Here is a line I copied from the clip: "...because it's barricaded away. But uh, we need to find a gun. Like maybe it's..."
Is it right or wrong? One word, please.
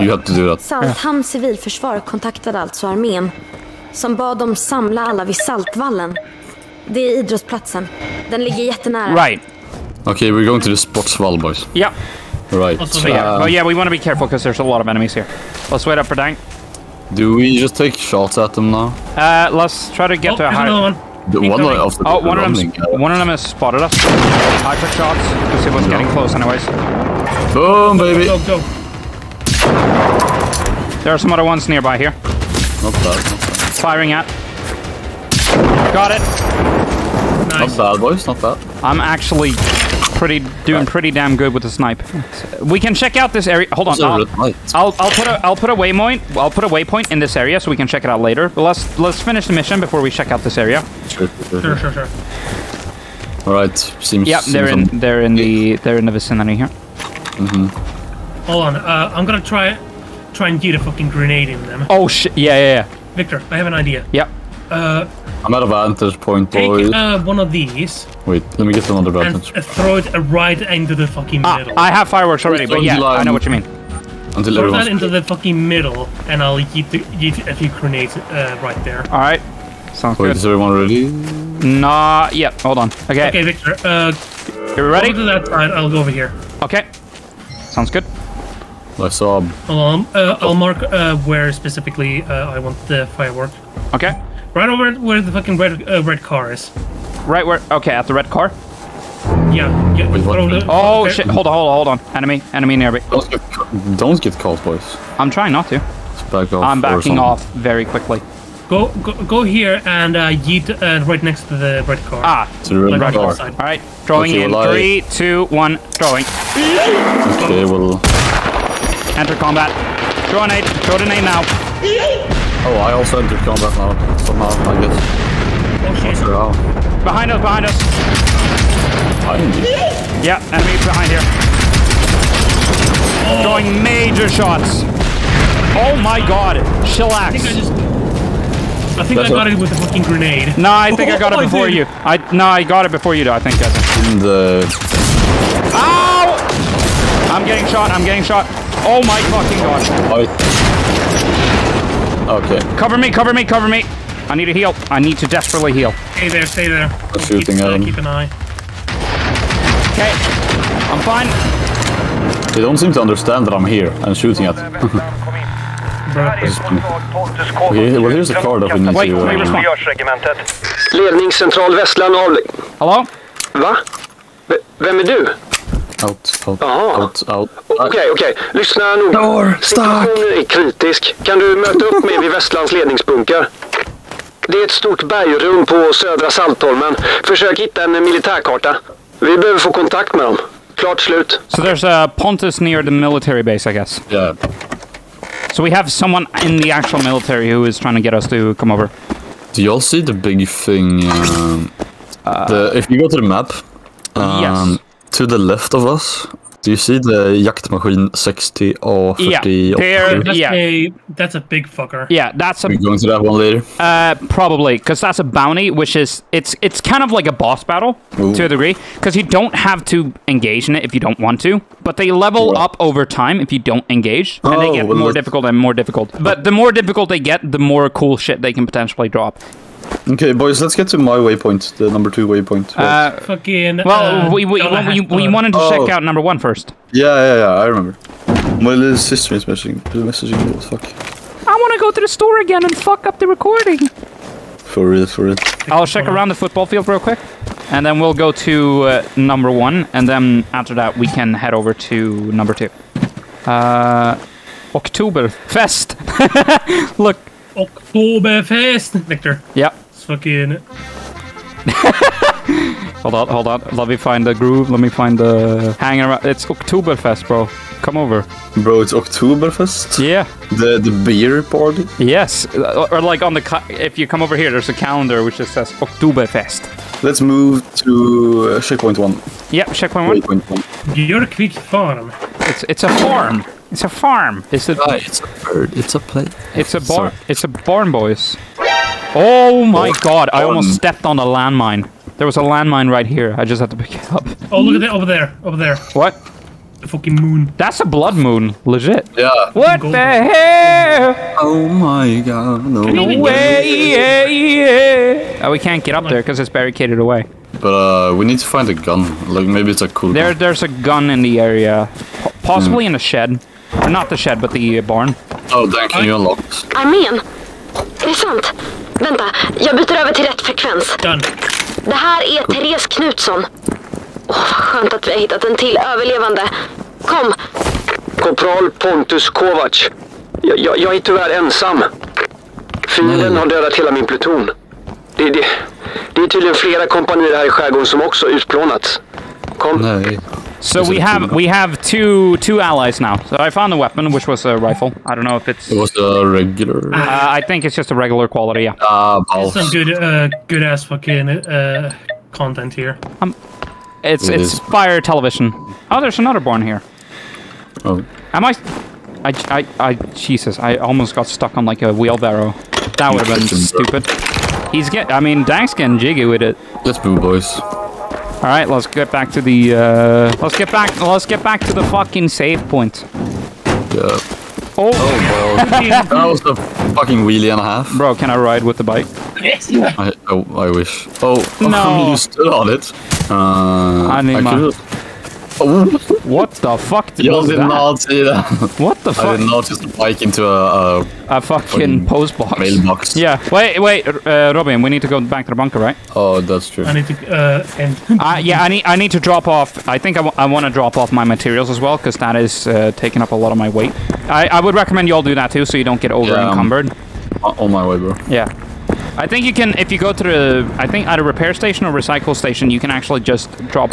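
right.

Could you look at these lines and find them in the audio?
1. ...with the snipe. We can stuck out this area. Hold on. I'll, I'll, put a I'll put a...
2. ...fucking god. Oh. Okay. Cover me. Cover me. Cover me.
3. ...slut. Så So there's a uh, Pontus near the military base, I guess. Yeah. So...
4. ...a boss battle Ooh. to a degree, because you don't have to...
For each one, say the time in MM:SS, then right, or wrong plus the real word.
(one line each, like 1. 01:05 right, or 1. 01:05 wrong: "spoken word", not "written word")
1. 00:41 wrong: "check", not "stuck"
2. 02:29 right
3. 03:10 right
4. 03:37 right.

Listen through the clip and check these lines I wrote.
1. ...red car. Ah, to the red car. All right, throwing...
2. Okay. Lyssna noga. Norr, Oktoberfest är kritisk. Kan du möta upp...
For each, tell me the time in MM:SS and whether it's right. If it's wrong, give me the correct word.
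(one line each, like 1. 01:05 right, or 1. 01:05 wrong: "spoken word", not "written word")
1. 01:51 right
2. 02:58 wrong: "Situationen", not "Oktoberfest".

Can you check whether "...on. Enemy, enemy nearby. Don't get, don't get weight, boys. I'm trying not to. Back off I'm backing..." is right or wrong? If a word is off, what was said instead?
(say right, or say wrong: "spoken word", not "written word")
wrong: "caught", not "weight".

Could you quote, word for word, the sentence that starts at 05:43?
So I found the weapon, which was a rifle.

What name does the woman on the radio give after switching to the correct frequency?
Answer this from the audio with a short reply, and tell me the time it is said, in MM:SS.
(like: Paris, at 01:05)
Therese Knutsson, at 05:22.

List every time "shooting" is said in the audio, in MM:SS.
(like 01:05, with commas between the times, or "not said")
02:37, 02:44.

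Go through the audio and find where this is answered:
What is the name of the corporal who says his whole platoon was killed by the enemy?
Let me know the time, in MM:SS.
05:28.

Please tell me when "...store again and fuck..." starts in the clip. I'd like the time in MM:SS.
04:02.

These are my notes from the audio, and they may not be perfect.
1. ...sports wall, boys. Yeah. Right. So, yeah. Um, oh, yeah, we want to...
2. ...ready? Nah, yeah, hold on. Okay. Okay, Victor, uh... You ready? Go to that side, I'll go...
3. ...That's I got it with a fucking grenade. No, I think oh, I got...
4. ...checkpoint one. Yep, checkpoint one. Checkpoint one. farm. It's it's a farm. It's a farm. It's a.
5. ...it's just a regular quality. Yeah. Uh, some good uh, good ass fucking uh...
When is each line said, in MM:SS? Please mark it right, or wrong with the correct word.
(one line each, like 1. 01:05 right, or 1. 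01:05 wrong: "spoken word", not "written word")
1. 00:10 right
2. 01:20 right
3. 02:19 right
4. 04:38 right
5. 05:47 right.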